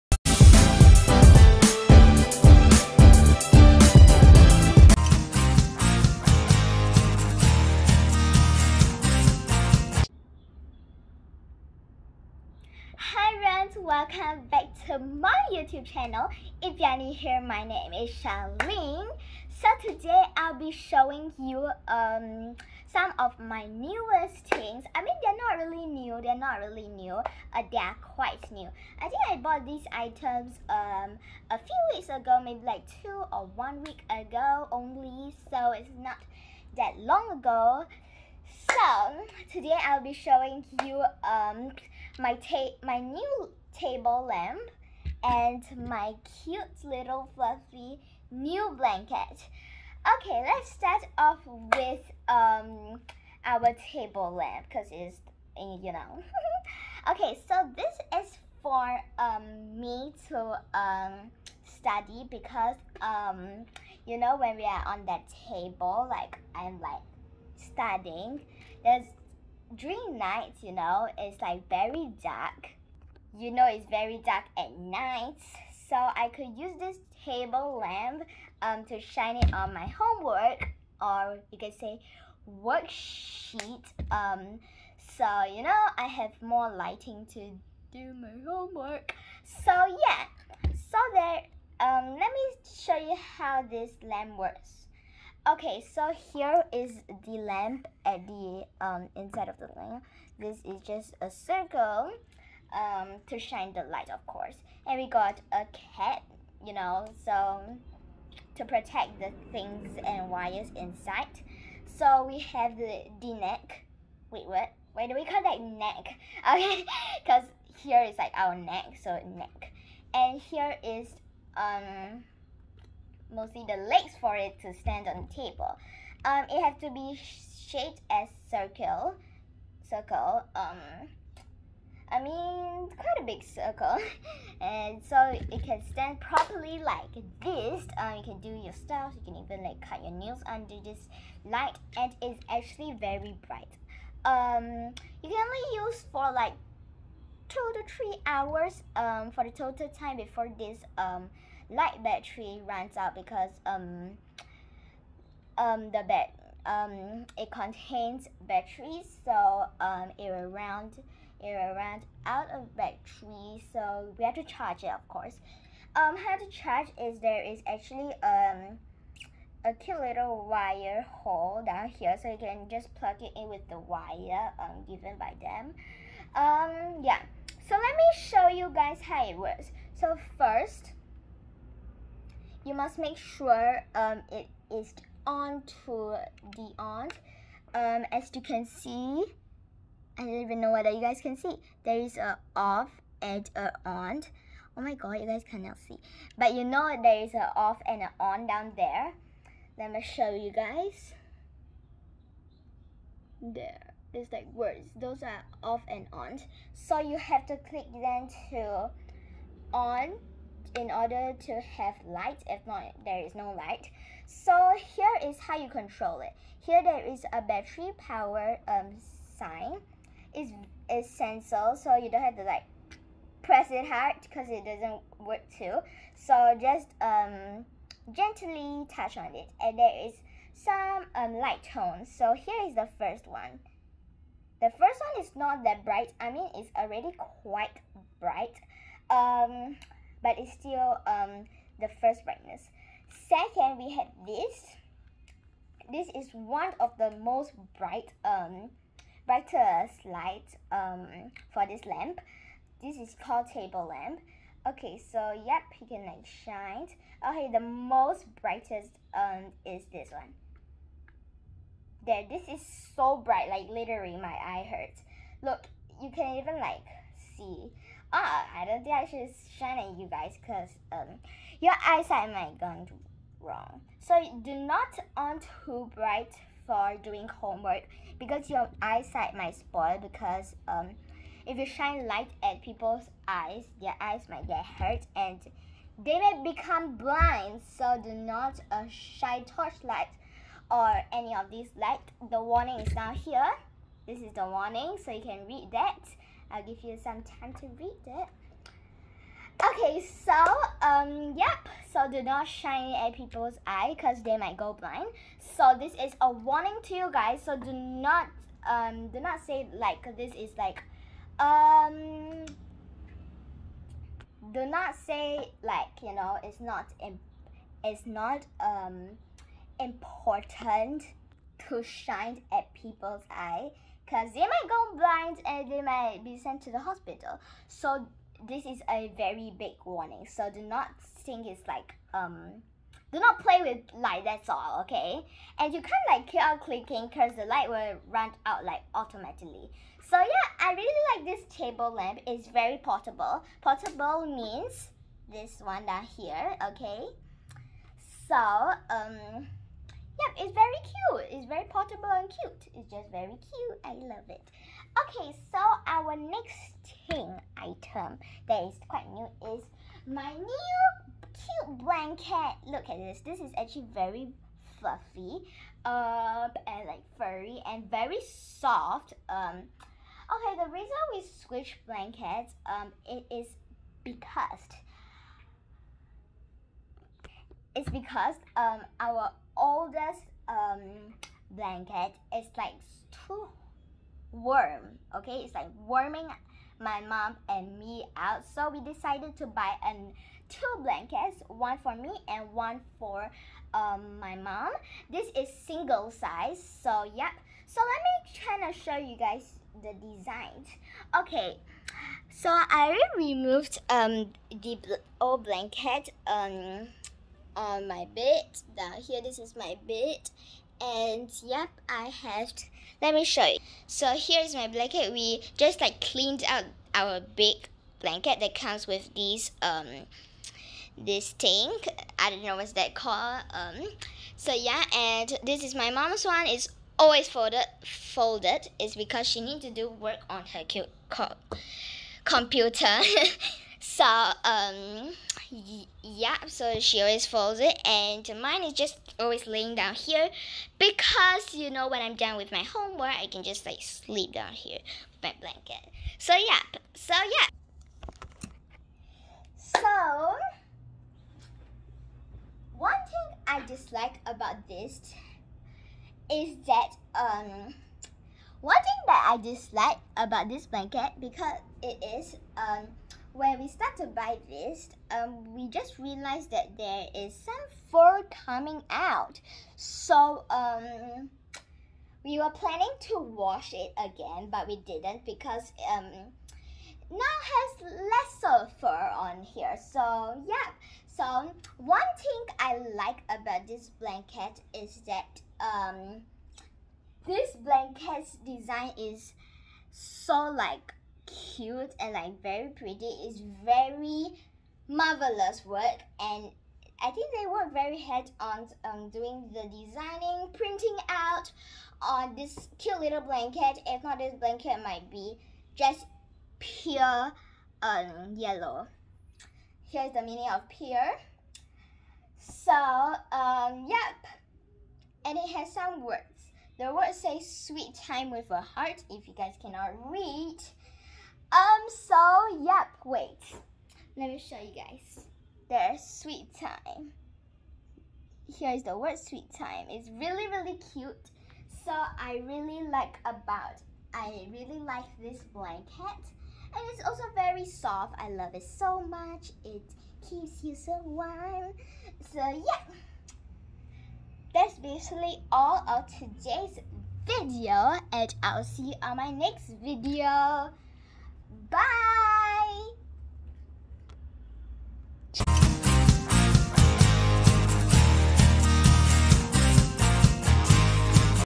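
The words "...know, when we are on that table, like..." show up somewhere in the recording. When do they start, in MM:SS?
01:04.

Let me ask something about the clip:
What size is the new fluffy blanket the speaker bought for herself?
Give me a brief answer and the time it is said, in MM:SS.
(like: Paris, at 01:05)
Single, at 06:35.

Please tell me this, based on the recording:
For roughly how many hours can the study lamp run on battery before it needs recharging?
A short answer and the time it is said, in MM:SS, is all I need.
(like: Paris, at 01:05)
2 to 3 hours, at 02:27.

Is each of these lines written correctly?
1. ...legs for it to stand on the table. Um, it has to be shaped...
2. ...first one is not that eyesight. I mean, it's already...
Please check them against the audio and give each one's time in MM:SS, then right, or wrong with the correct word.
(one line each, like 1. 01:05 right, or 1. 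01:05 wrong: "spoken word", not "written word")
1. 02:03 right
2. 03:54 wrong: "bright", not "eyesight".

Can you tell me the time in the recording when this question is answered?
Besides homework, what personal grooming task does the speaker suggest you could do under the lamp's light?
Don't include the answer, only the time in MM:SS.
02:19.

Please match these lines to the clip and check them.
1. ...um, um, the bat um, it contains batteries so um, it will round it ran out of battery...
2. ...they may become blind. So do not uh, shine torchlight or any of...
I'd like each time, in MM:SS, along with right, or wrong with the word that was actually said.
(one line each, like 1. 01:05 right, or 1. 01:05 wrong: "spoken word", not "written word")
1. 02:33 right
2. 04:46 right.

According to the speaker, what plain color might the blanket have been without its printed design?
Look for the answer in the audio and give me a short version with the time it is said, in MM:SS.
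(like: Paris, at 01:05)
Yellow, at 08:28.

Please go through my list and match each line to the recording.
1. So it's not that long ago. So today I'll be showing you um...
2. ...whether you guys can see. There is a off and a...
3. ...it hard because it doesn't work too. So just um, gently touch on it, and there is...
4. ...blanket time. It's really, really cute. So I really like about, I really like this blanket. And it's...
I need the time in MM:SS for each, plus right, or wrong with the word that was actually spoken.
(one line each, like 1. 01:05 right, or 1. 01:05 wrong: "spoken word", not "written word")
1. 00:35 right
2. 03:10 right
3. 03:43 right
4. 08:49 wrong: "sweet", not "blanket".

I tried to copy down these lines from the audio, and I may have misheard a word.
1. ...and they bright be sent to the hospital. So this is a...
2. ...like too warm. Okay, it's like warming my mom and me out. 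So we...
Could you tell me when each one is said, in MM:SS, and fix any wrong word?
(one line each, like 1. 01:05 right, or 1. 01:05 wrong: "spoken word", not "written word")
1. 05:25 wrong: "might", not "bright"
2. 06:22 right.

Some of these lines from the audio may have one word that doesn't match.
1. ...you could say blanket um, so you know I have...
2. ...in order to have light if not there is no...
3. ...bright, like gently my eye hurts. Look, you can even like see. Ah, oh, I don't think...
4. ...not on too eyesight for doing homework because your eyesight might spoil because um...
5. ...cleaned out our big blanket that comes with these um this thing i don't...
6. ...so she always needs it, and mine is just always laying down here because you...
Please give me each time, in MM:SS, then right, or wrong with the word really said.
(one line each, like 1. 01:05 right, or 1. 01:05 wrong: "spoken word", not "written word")
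1. 01:21 wrong: "worksheet", not "blanket"
2. 03:30 right
3. 04:23 wrong: "literally", not "gently"
4. 04:34 wrong: "bright", not "eyesight"
5. 06:56 right
6. 07:16 wrong: "folds", not "needs".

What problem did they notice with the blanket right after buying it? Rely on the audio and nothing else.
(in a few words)
Fur coming out.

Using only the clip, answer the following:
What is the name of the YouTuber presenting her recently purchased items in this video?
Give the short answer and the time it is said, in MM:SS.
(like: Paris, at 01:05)
Charlene, at 00:18.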